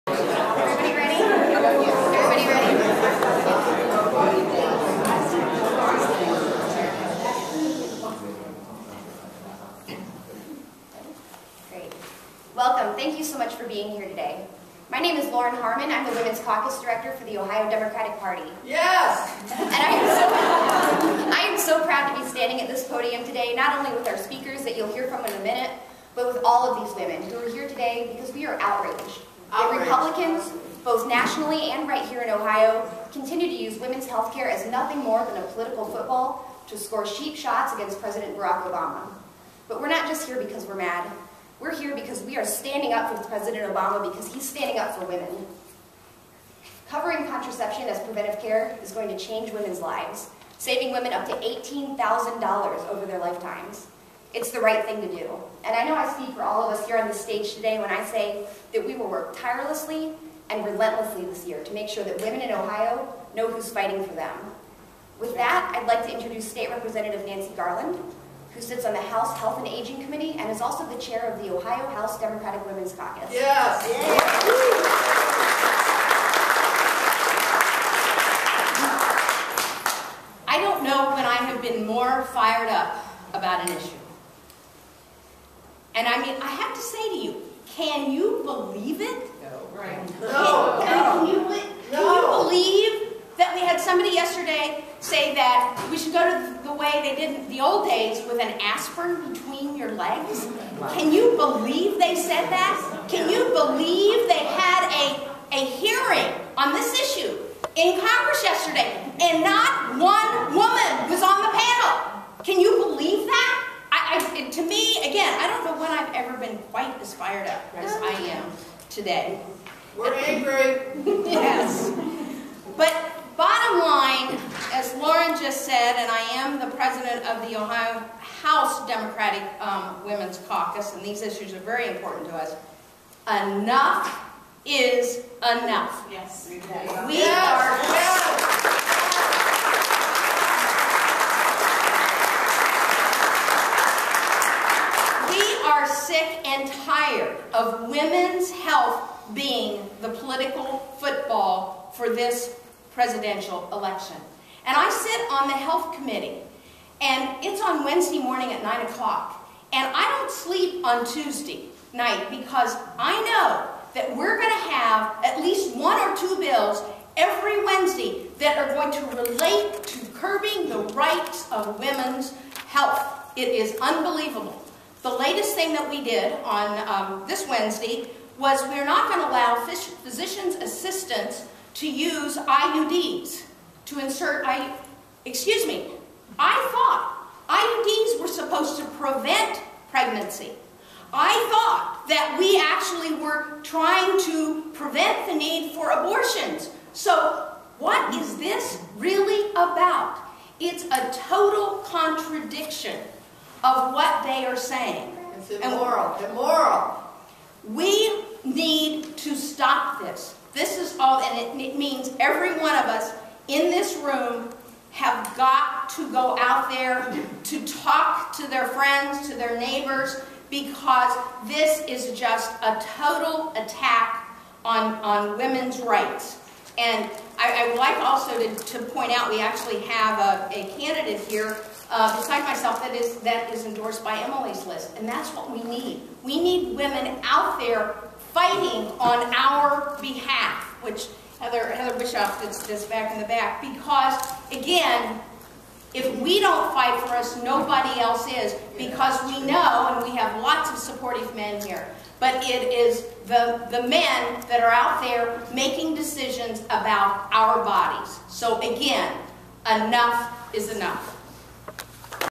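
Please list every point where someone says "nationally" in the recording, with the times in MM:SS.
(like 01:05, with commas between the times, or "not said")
00:31.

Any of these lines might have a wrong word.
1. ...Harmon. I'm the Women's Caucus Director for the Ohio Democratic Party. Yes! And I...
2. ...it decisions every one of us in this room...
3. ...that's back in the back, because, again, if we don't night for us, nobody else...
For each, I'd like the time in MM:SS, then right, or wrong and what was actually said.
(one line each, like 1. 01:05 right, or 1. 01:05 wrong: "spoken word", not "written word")
1. 00:15 right
2. 03:31 wrong: "means", not "decisions"
3. 04:02 wrong: "fight", not "night".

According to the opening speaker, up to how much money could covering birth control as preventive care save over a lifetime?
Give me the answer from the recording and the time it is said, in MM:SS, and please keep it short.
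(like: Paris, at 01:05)
$18,000, at 00:51.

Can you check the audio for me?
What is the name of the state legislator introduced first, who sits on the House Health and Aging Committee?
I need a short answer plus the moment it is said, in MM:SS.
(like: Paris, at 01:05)
Nancy Garland, at 01:07.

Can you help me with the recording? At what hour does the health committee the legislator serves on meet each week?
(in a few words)
9 o'clock.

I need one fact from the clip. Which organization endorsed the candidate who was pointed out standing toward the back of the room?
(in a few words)
Emily's List.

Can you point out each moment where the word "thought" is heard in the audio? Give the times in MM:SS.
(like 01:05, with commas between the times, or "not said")
03:06, 03:11.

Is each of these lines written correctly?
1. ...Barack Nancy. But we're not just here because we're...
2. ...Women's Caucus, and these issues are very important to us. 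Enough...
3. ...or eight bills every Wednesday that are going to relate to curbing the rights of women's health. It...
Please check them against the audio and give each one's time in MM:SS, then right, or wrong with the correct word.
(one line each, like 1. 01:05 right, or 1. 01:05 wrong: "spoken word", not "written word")
1. 00:38 wrong: "Obama", not "Nancy"
2. 02:10 right
3. 02:45 wrong: "two", not "eight".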